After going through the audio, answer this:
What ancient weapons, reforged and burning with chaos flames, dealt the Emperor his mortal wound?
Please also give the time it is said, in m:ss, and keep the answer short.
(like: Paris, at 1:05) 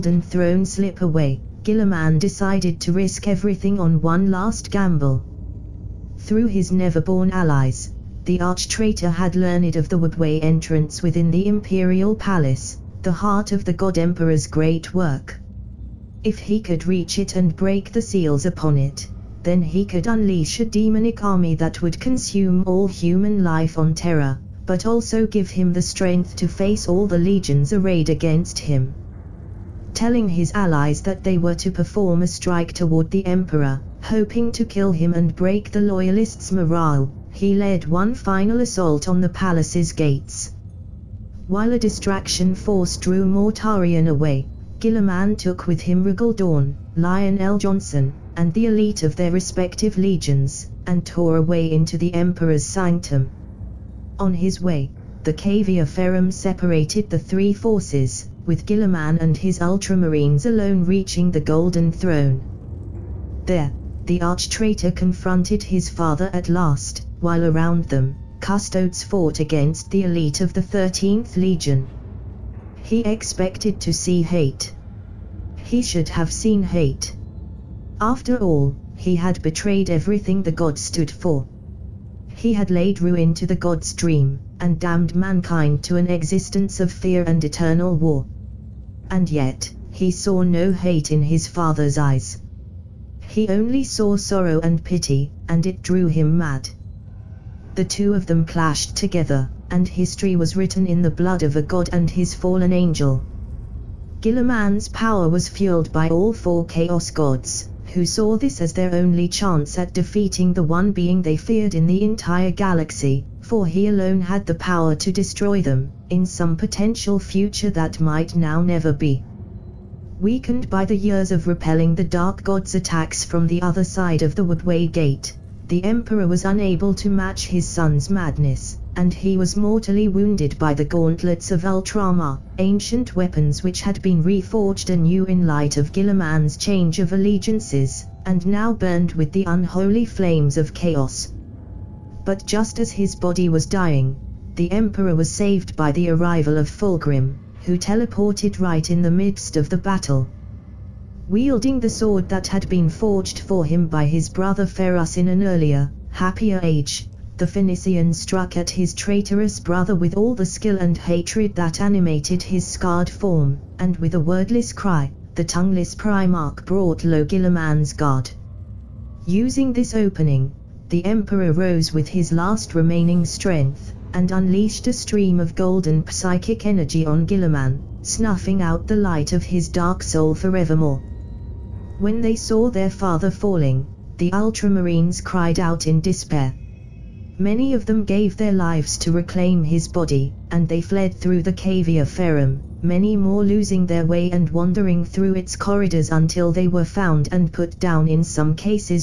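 Gauntlets of Ultramar, at 2:10.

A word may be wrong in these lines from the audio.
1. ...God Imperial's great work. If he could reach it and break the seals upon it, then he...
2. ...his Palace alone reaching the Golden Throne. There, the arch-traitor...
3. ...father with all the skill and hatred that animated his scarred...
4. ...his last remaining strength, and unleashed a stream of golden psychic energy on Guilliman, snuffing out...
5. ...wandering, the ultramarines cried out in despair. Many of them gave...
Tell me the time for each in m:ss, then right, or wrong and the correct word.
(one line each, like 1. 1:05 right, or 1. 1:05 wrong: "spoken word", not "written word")
1. 0:13 wrong: "Emperor", not "Imperial"
2. 0:59 wrong: "Ultramarines", not "Palace"
3. 2:39 wrong: "brother", not "father"
4. 2:52 right
5. 3:03 wrong: "falling", not "wandering".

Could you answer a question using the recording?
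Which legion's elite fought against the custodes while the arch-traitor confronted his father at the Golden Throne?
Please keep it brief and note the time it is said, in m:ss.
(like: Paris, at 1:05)
13th Legion, at 1:10.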